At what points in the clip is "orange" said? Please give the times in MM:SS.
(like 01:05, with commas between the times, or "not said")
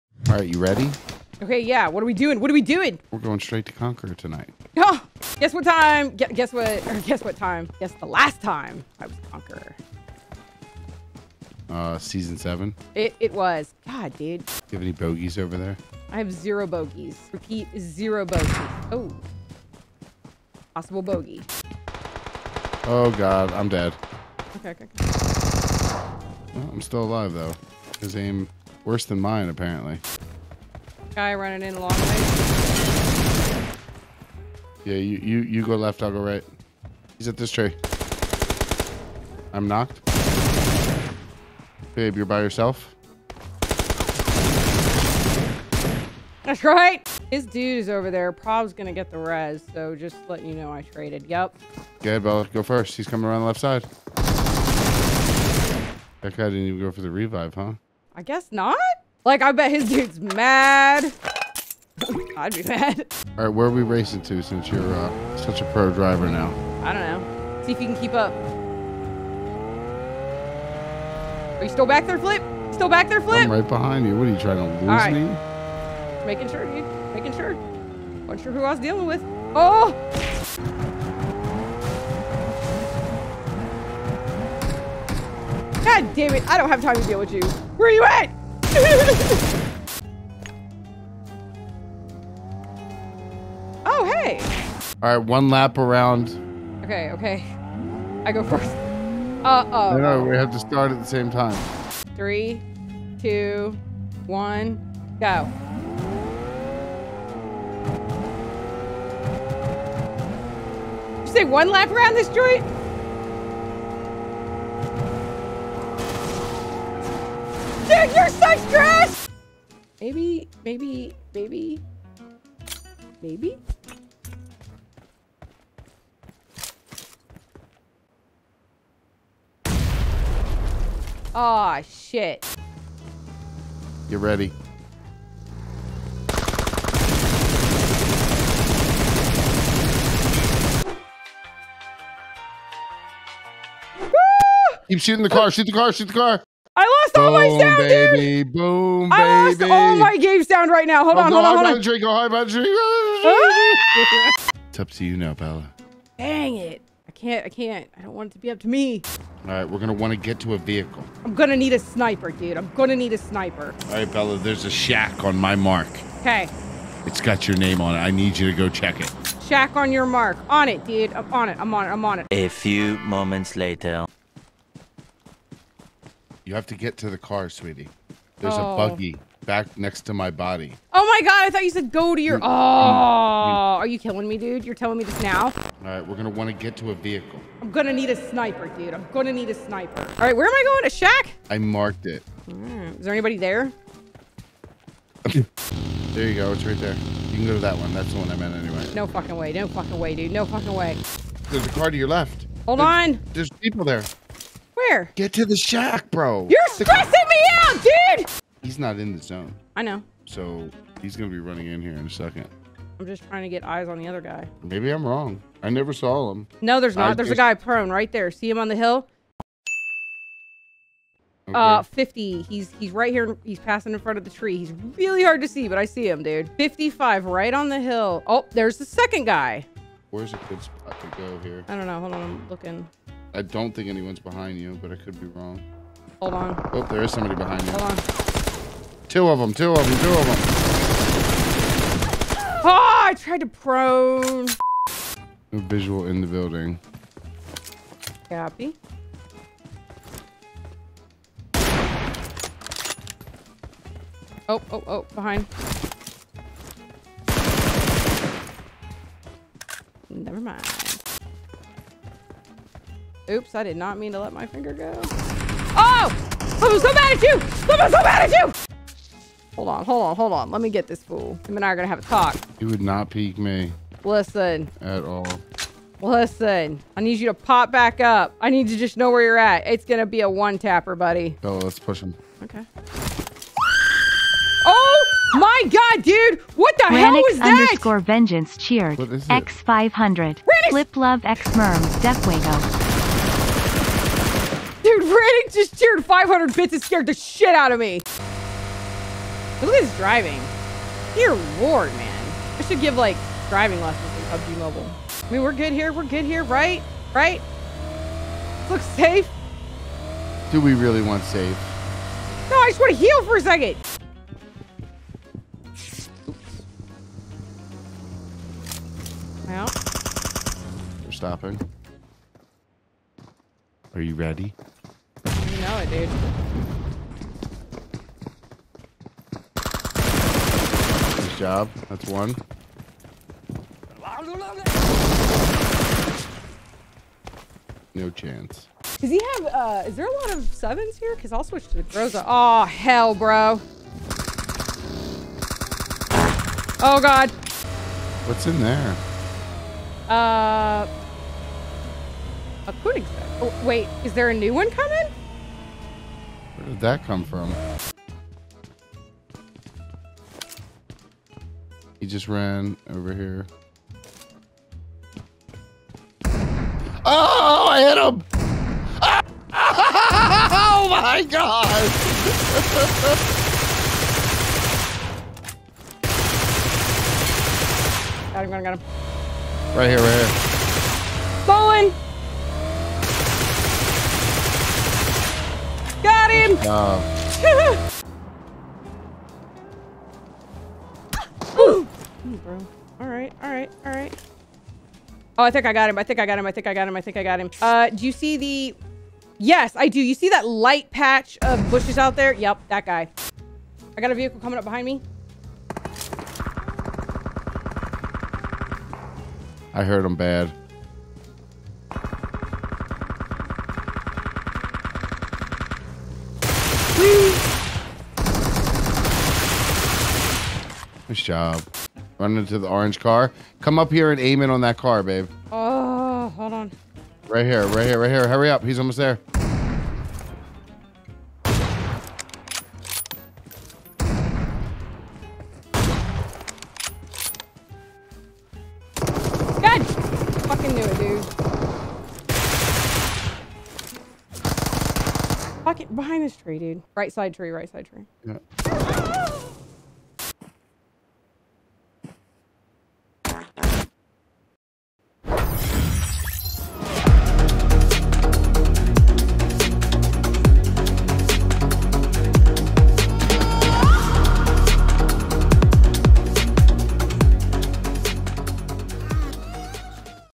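07:02.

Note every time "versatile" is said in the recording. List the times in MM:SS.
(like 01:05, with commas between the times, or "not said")
not said.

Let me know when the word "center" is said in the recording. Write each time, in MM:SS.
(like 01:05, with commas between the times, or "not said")
not said.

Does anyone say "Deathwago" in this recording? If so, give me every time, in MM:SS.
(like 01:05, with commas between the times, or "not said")
04:52.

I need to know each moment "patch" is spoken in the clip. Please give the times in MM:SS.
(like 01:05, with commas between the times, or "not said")
06:40.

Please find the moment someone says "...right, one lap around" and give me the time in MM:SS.
01:35.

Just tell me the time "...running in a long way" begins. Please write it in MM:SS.
00:31.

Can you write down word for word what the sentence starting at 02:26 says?
I lost boom, all my sound, baby.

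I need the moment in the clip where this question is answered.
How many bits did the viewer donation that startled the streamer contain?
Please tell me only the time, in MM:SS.
04:56.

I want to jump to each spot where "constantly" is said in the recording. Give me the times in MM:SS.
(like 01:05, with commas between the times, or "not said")
not said.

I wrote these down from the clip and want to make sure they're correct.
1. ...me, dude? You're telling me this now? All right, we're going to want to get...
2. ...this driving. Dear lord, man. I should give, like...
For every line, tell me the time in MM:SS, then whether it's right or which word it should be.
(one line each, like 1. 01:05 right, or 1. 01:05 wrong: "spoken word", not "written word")
1. 03:04 right
2. 04:59 right.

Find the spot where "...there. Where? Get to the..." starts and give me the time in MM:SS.
03:23.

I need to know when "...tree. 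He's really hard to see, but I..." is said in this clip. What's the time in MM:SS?
03:44.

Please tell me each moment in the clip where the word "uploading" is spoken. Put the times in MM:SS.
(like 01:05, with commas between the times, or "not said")
not said.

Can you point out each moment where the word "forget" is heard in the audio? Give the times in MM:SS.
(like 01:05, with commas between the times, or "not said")
not said.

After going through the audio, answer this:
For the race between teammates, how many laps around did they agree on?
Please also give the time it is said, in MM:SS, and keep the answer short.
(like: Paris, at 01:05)
1, at 01:51.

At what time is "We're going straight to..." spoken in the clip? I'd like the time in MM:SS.
00:03.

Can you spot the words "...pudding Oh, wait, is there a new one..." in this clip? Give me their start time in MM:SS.
05:52.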